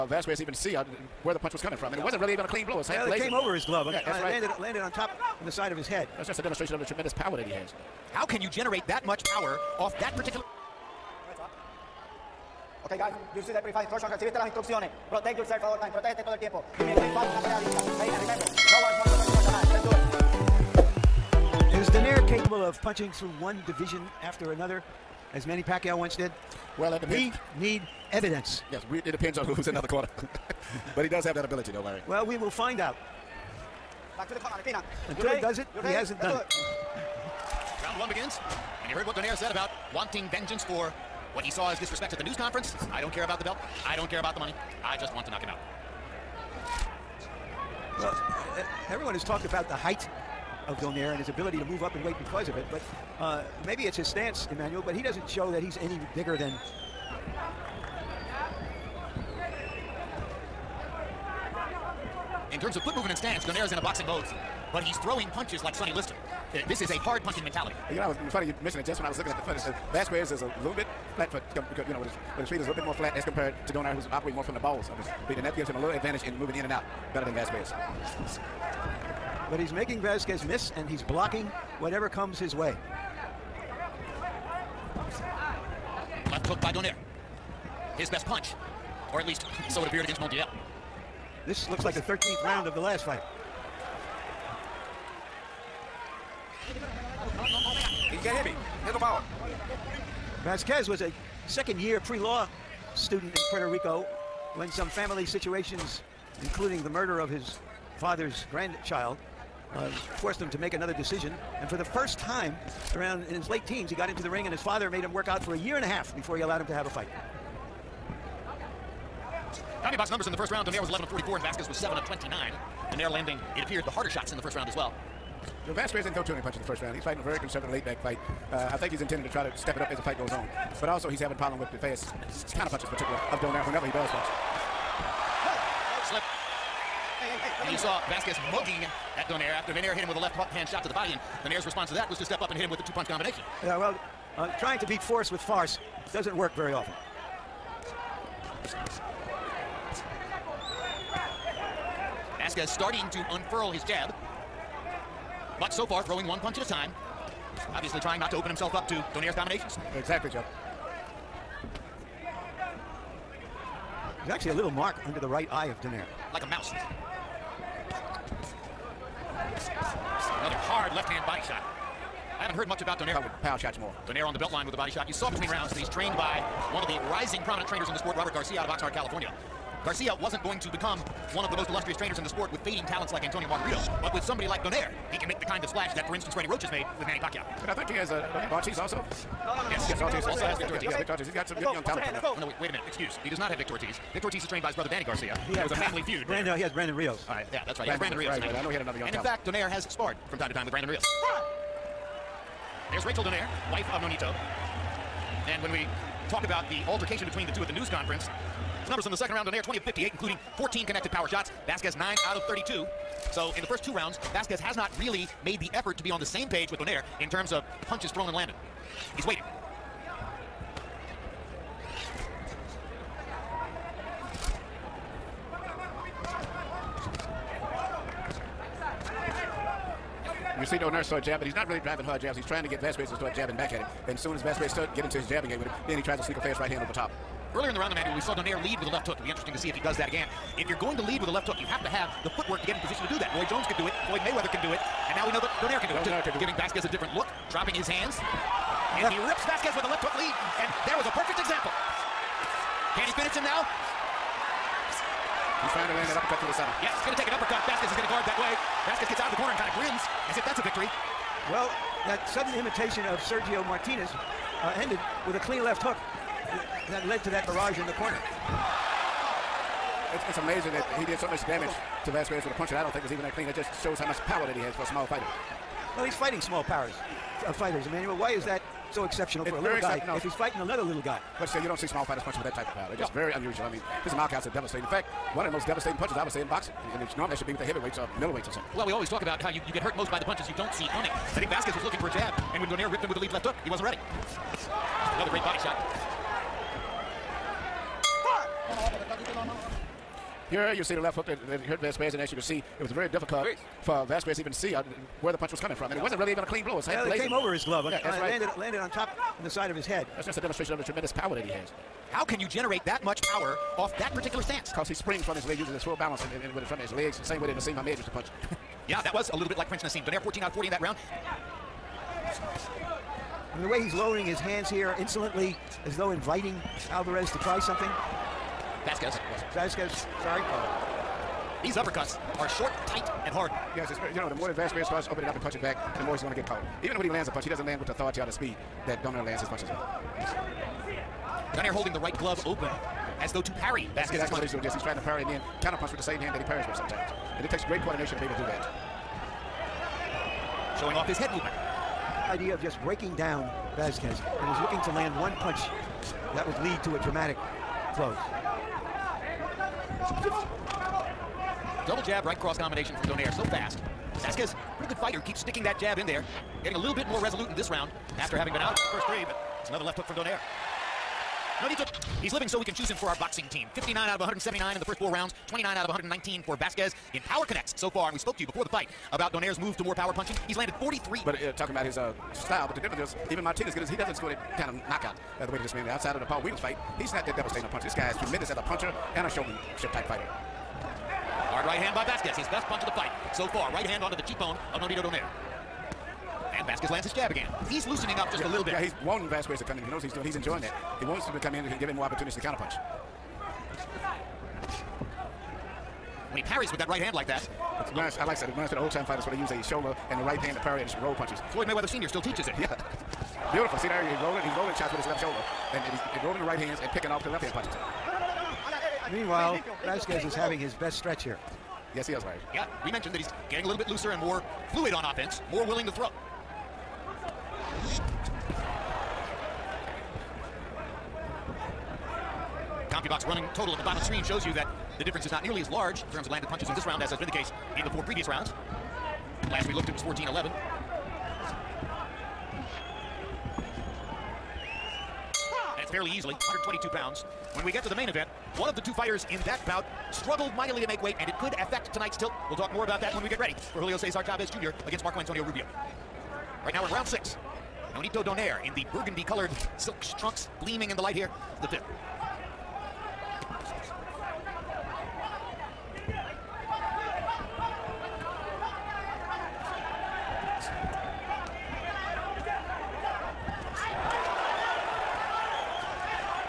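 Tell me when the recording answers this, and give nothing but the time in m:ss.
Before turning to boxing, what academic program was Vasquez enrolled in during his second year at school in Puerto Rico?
1:42.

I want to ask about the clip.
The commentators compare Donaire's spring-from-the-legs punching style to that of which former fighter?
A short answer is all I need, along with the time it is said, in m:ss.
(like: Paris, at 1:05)
Naseem Hamed, at 5:17.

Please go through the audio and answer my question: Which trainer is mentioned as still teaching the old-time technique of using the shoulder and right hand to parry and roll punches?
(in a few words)
Floyd Mayweather Sr.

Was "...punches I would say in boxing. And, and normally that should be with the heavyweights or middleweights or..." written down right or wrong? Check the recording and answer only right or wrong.
right.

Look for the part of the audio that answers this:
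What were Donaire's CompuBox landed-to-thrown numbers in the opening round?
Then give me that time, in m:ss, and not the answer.
2:00.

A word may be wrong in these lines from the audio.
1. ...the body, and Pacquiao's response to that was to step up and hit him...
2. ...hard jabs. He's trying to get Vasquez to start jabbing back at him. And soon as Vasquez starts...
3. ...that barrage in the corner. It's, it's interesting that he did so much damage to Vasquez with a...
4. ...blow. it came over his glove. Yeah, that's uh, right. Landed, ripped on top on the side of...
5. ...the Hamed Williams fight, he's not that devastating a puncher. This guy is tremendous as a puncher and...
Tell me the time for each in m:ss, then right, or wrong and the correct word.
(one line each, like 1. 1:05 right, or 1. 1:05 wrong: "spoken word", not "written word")
1. 2:20 wrong: "Donaire", not "Pacquiao"
2. 3:52 right
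3. 4:27 wrong: "amazing", not "interesting"
4. 5:06 wrong: "landed", not "ripped"
5. 6:26 wrong: "Paul", not "Hamed".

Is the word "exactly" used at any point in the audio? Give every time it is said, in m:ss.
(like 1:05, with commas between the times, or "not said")
2:39, 5:44.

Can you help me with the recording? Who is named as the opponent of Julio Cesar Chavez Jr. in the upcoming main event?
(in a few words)
Marco Antonio Rubio.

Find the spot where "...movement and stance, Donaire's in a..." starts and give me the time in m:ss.
1:02.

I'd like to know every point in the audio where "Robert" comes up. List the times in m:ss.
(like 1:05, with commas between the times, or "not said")
2:58.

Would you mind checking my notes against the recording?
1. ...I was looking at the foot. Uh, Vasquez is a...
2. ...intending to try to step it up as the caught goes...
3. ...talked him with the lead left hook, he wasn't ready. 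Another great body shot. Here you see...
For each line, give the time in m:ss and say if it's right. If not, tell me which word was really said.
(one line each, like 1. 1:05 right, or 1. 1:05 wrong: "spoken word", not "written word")
1. 1:09 right
2. 2:08 wrong: "fight", not "caught"
3. 4:52 wrong: "ripped", not "talked".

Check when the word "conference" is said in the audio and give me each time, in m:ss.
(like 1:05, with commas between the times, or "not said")
0:42, 3:27.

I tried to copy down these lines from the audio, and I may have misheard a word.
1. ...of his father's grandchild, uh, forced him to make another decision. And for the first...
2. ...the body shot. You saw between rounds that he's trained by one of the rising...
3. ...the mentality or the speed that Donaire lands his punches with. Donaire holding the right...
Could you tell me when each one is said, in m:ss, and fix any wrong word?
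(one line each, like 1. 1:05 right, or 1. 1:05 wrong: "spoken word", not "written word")
1. 1:47 right
2. 2:54 right
3. 5:37 wrong: "authority", not "mentality".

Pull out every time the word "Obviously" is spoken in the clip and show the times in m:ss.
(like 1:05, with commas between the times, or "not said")
2:37.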